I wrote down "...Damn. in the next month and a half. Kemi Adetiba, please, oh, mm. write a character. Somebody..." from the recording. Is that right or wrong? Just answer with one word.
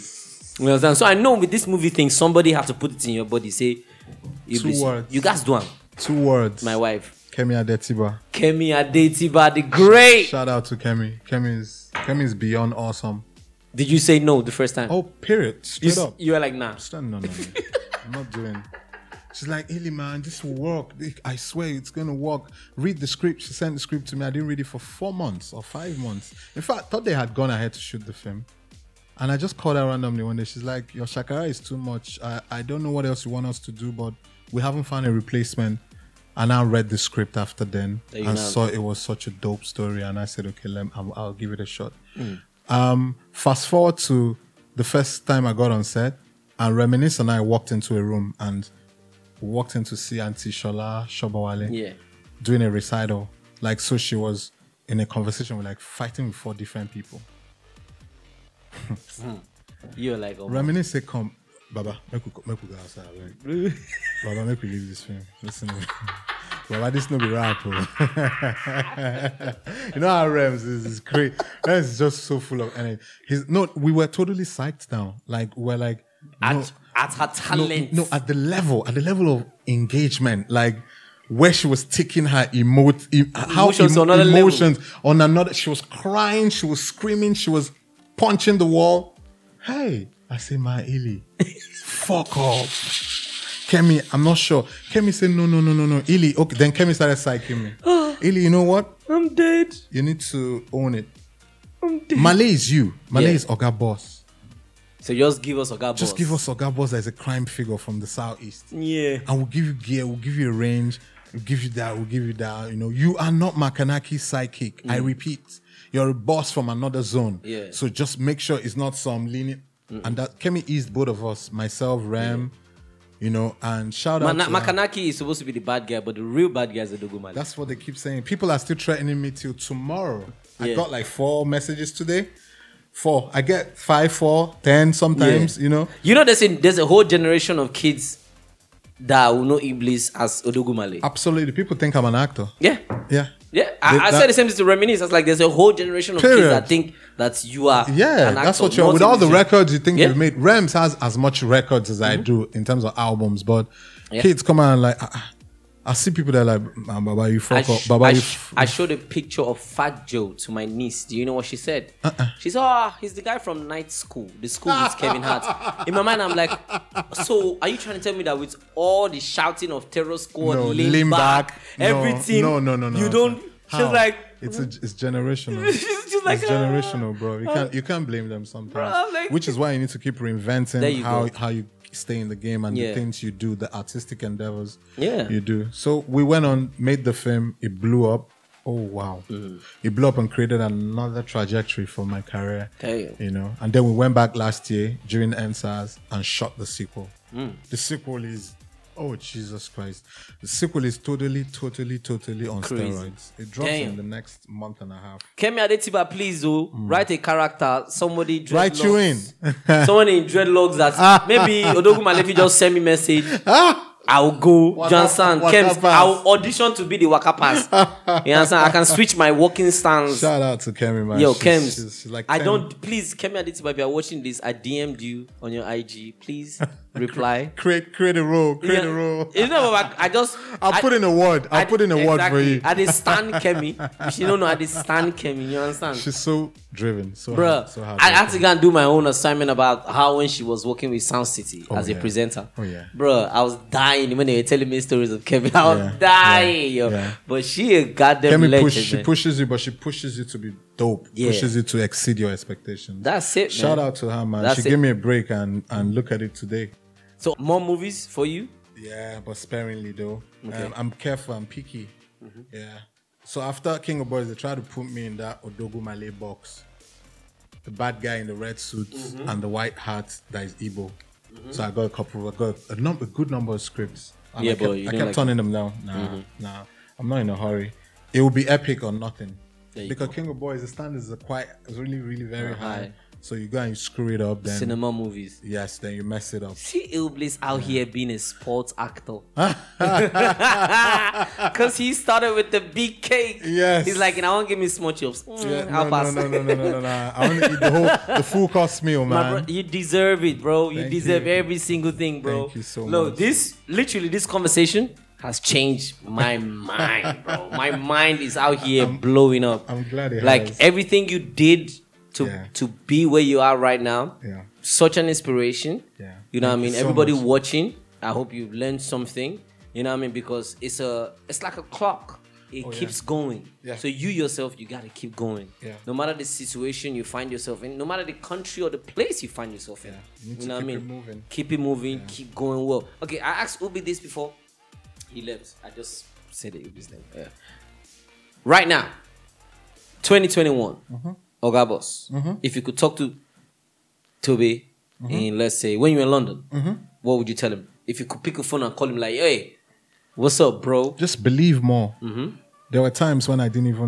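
right.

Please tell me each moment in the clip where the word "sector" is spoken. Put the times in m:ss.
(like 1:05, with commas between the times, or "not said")
not said.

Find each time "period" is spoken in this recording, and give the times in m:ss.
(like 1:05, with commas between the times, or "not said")
0:15, 2:26.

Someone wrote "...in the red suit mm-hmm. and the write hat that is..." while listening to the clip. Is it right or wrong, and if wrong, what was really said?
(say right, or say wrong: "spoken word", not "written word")
wrong: "white", not "write".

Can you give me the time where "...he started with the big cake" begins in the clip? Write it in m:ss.
4:51.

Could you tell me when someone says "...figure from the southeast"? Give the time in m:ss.
1:47.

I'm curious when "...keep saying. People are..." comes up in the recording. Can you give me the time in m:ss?
2:07.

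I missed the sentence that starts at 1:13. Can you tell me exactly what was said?
He's, no, we were totally psyched down.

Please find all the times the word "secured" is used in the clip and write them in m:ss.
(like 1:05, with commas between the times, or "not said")
not said.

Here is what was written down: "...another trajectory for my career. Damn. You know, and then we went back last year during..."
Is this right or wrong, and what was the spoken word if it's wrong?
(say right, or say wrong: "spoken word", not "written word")
right.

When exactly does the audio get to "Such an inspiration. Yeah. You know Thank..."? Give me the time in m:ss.
5:14.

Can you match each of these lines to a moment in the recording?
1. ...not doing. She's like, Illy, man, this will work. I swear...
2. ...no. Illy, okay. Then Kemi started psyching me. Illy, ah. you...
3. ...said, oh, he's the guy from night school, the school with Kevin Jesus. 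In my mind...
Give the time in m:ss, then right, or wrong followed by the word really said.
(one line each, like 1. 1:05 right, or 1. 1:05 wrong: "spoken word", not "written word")
1. 0:18 right
2. 1:35 right
3. 2:42 wrong: "Hart", not "Jesus".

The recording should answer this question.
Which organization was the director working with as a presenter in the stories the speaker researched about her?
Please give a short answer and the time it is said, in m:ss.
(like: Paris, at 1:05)
Sound City, at 4:01.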